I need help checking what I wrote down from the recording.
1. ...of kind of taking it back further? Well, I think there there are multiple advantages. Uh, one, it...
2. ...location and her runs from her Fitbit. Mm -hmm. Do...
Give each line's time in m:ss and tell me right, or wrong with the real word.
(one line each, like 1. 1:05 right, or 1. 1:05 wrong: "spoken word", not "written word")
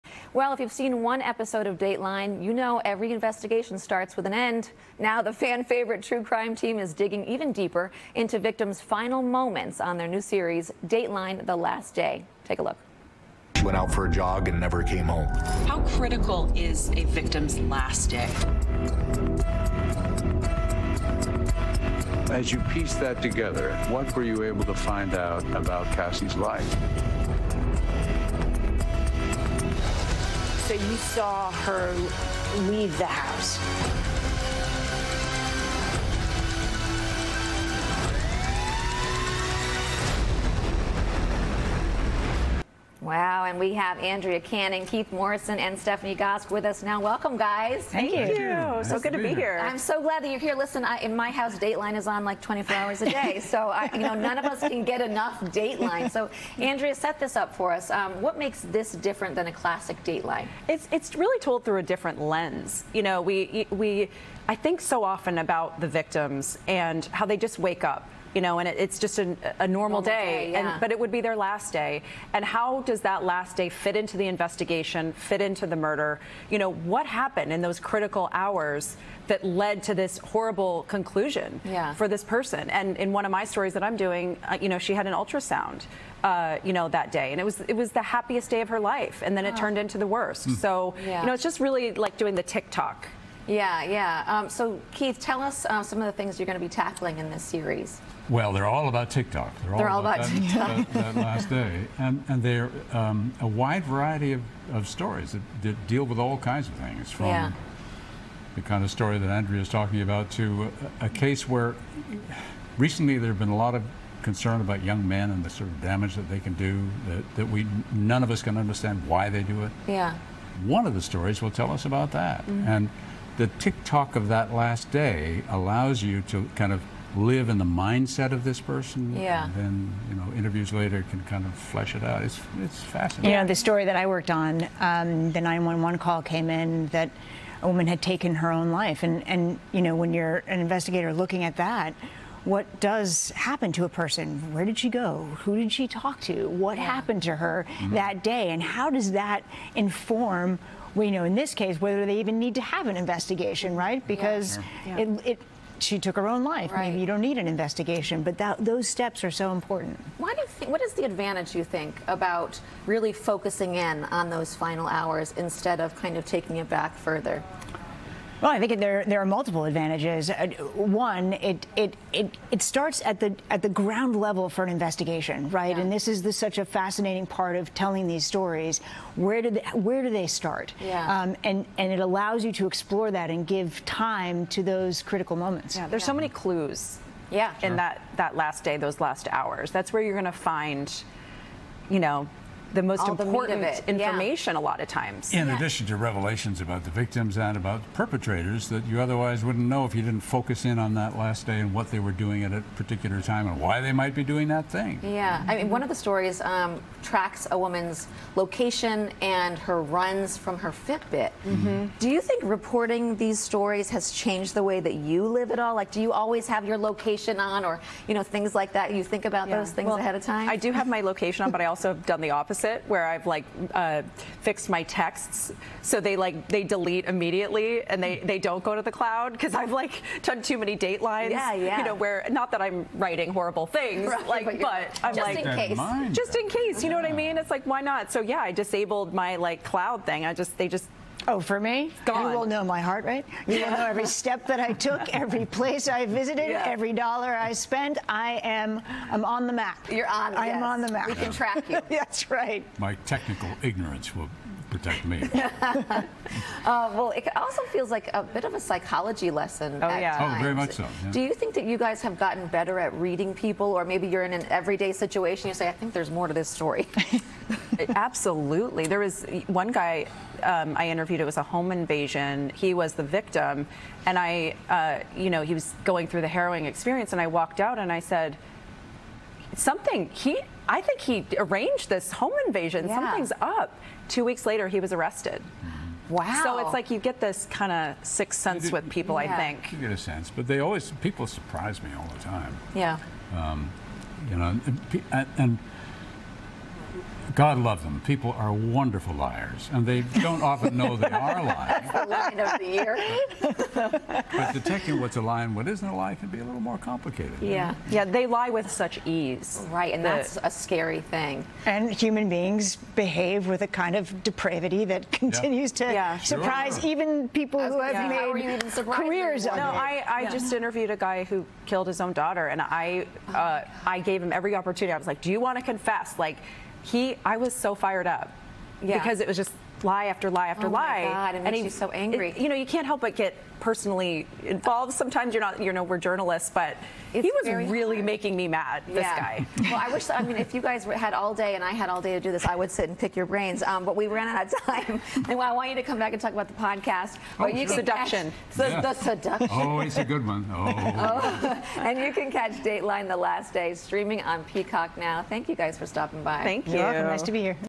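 1. 2:45 right
2. 3:28 right.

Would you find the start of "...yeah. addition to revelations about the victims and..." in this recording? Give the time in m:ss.
3:15.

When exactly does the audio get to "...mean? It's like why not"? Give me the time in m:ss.
3:57.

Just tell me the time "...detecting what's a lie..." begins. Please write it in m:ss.
5:04.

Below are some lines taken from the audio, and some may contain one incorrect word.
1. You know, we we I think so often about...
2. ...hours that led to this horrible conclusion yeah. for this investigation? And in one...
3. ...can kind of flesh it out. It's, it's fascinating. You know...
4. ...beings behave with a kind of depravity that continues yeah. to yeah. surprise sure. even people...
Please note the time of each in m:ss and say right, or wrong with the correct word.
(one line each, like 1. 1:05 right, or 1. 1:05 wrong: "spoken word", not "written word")
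1. 1:02 right
2. 1:18 wrong: "person", not "investigation"
3. 2:11 right
4. 5:12 right.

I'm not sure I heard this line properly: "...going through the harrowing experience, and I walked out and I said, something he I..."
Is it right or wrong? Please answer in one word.
right.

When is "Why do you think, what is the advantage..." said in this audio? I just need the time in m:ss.
2:40.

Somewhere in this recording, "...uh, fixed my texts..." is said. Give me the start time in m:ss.
3:43.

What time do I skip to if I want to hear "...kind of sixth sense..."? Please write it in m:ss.
4:47.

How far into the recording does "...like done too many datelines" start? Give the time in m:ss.
3:49.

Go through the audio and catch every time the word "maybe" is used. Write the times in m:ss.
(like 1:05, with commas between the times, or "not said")
2:36, 4:23.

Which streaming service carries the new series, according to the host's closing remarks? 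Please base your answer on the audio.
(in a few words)
Peacock.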